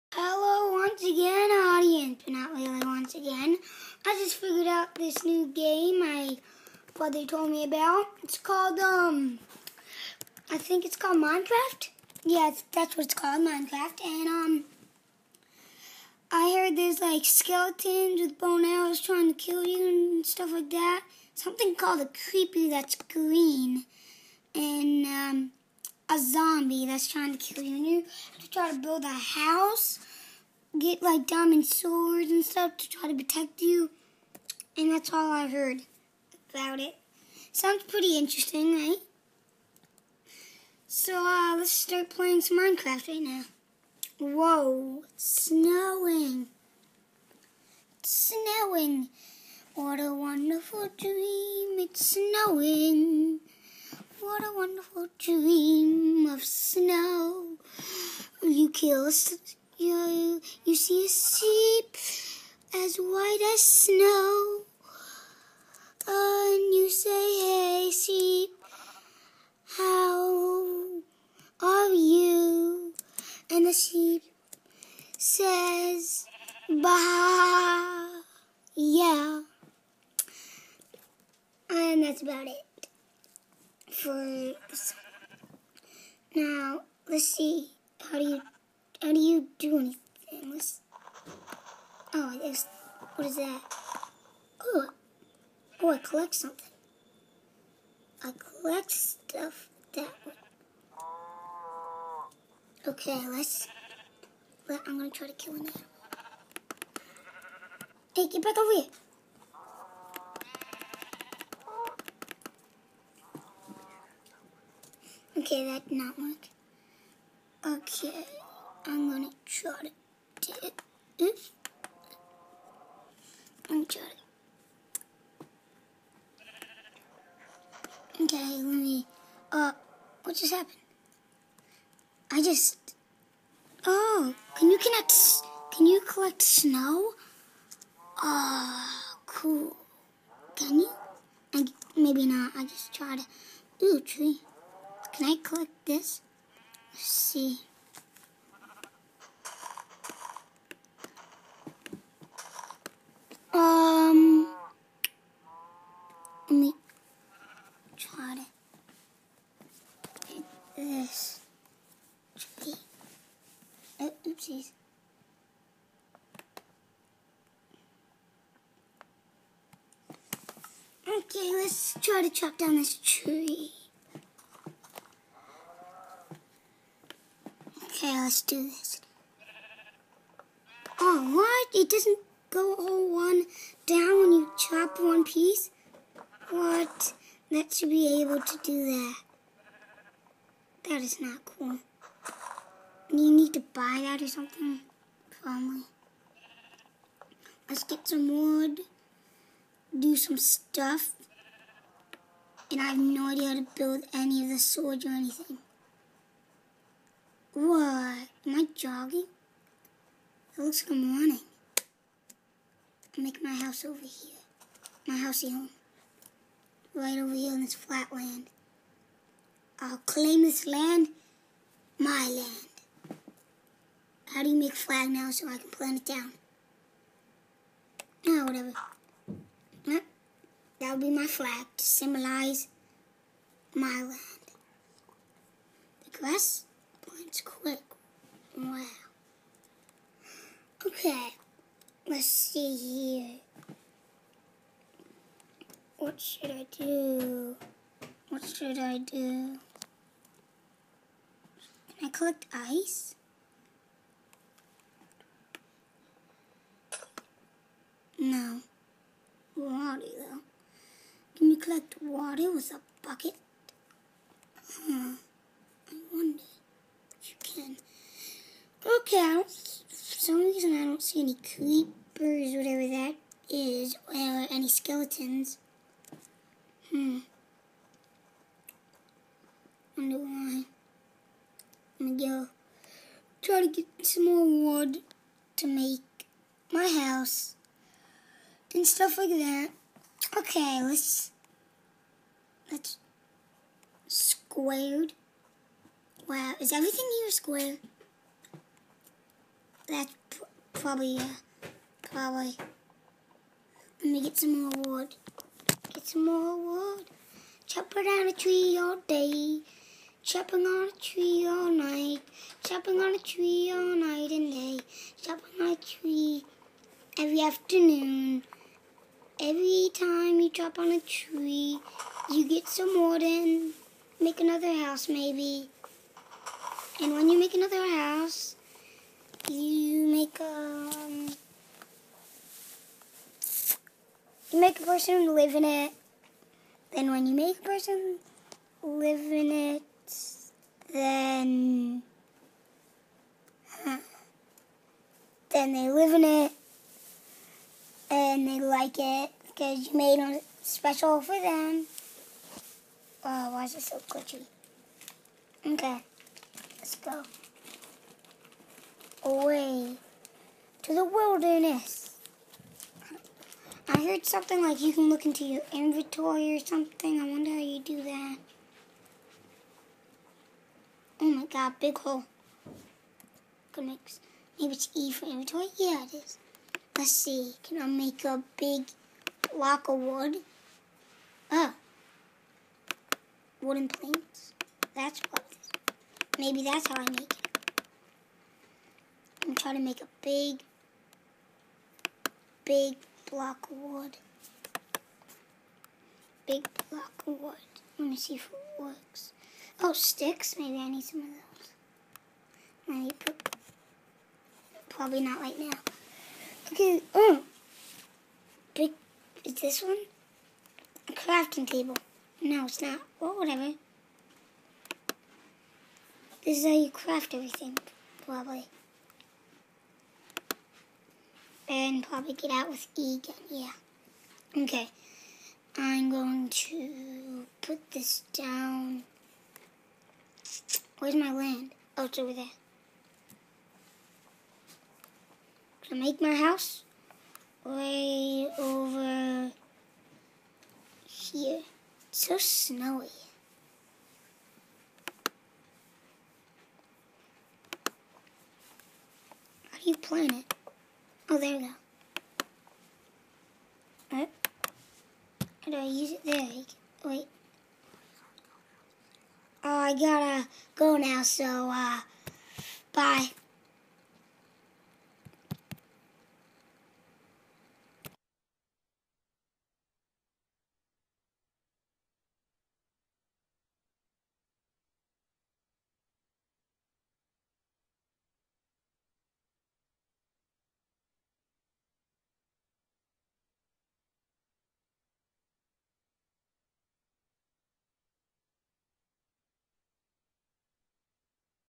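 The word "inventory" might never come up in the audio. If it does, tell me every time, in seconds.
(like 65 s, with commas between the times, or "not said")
365 s, 375 s.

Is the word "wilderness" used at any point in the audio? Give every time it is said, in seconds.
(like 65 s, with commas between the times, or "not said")
361 s.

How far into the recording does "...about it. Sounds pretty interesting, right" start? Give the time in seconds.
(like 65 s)
36 s.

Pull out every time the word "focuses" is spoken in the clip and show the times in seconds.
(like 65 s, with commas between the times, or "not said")
not said.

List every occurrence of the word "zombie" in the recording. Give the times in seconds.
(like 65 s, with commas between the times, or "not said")
26 s.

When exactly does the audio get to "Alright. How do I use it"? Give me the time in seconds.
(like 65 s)
454 s.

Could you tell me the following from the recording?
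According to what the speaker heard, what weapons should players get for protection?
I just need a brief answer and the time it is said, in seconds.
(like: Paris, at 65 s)
Diamond swords, at 31 s.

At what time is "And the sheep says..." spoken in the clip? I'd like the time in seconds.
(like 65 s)
73 s.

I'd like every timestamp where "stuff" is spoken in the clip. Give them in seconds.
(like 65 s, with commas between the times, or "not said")
20 s, 32 s, 98 s, 200 s, 288 s.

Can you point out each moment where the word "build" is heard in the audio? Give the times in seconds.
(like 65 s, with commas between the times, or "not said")
28 s, 203 s.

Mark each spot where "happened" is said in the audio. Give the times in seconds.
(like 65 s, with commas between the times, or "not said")
130 s.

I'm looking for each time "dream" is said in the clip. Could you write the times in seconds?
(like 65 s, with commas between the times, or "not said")
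50 s, 55 s.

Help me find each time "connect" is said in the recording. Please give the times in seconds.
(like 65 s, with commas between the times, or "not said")
134 s.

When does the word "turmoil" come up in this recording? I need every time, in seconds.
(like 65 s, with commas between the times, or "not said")
not said.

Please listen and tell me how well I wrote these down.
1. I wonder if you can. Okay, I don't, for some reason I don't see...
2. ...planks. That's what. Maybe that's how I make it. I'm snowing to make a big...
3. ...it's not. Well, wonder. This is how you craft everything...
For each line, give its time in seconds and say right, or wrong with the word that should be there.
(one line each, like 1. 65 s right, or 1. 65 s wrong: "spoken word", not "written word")
1. 265 s right
2. 383 s wrong: "trying", not "snowing"
3. 412 s wrong: "whatever", not "wonder".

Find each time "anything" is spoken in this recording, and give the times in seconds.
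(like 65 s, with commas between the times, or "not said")
89 s, 205 s.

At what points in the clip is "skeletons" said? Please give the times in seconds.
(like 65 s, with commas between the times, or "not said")
17 s, 274 s.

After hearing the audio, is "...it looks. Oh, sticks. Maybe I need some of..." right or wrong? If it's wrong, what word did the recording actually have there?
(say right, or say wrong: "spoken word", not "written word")
wrong: "works", not "looks".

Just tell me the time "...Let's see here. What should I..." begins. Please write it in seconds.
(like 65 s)
242 s.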